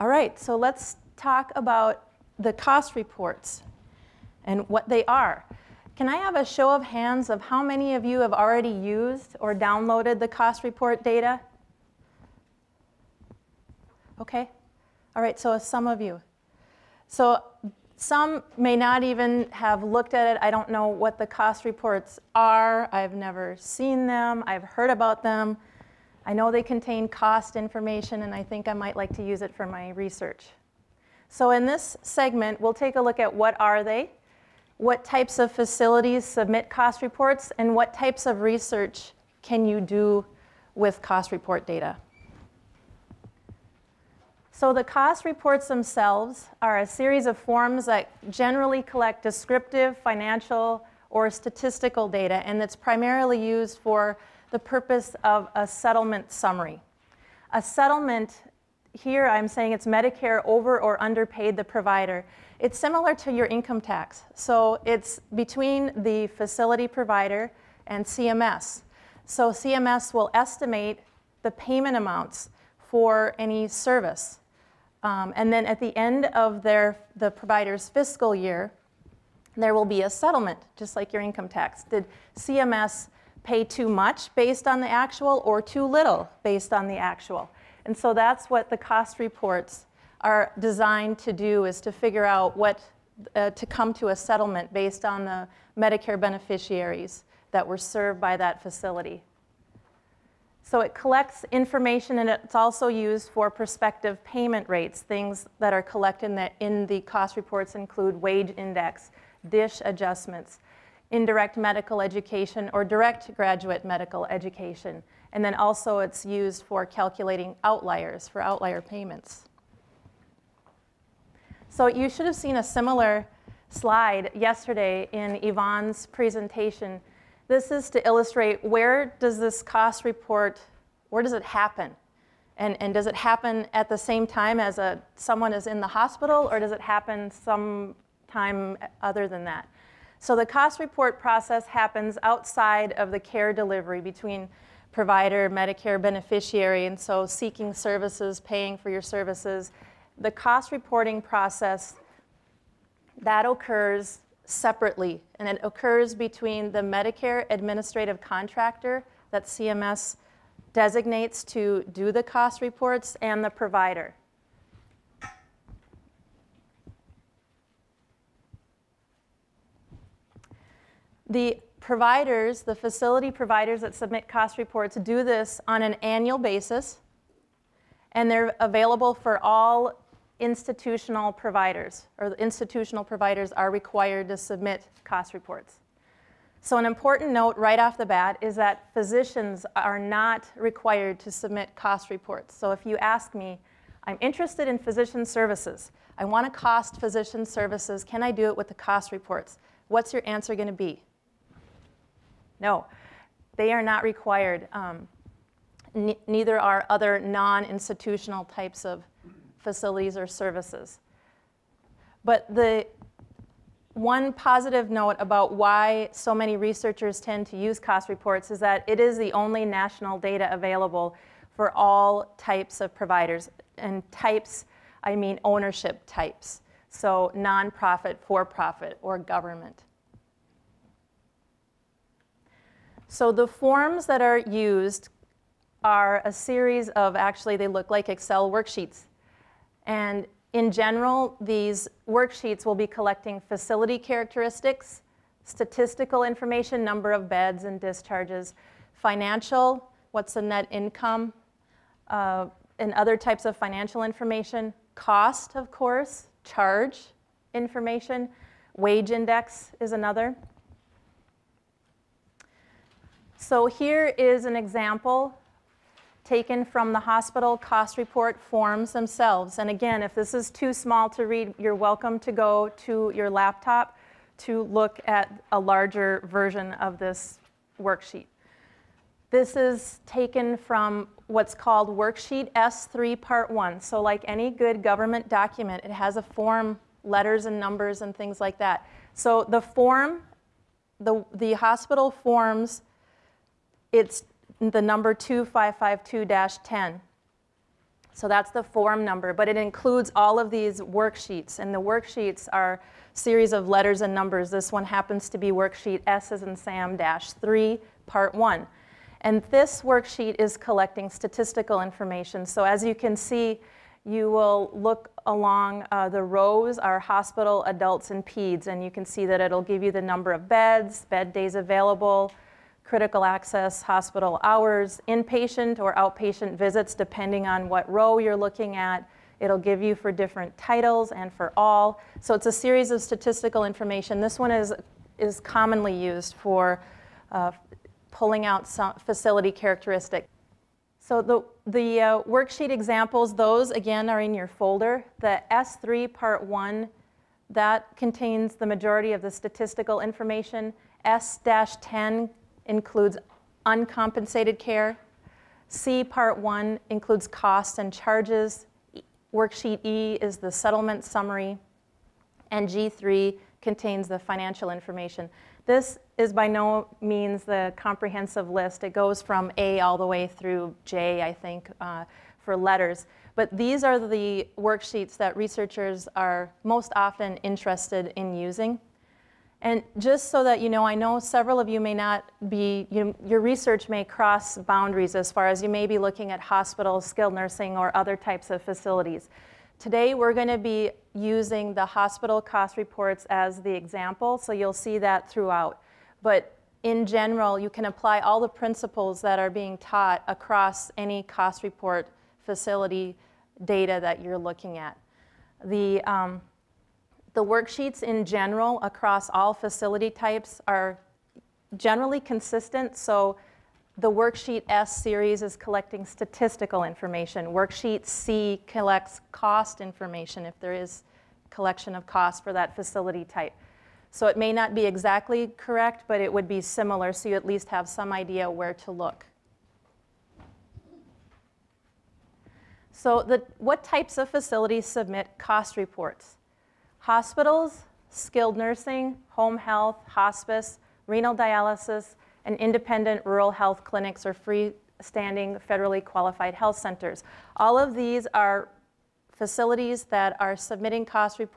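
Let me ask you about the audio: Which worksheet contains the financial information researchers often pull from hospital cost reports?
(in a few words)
G3.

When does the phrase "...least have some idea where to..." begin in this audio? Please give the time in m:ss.
7:07.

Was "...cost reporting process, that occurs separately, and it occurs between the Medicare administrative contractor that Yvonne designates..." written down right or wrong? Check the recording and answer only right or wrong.
wrong.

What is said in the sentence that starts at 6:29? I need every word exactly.
Today, we're going to be using the hospital cost reports as the example, so you'll see that throughout.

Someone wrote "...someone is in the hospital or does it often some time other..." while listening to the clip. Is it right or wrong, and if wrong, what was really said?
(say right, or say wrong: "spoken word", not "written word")
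wrong: "happen", not "often".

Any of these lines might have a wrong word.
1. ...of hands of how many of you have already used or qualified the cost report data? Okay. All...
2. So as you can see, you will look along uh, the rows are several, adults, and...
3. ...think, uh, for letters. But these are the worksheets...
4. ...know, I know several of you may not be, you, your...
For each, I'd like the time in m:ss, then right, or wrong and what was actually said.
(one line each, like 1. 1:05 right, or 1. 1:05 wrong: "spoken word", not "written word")
1. 0:06 wrong: "downloaded", not "qualified"
2. 5:12 wrong: "hospital", not "several"
3. 6:11 right
4. 6:20 right.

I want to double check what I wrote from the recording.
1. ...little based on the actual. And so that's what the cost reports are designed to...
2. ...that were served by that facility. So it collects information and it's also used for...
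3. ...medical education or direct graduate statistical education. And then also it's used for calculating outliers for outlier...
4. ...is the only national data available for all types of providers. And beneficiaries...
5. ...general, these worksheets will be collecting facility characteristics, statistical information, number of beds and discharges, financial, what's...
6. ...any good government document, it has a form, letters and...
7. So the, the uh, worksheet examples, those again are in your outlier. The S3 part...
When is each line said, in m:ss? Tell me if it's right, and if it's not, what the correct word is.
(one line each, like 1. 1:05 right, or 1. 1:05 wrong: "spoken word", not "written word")
1. 1:25 right
2. 1:37 right
3. 1:51 wrong: "medical", not "statistical"
4. 3:38 wrong: "types", not "beneficiaries"
5. 4:00 right
6. 4:44 right
7. 5:40 wrong: "folder", not "outlier".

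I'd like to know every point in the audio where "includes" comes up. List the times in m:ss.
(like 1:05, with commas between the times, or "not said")
1:47, 4:59, 5:52, 5:56.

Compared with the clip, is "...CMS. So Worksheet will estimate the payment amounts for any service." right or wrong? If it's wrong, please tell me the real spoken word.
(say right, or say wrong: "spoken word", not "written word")
wrong: "CMS", not "Worksheet".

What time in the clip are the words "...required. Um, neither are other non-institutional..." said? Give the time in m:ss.
3:24.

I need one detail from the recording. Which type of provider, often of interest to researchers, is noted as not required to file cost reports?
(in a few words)
physicians.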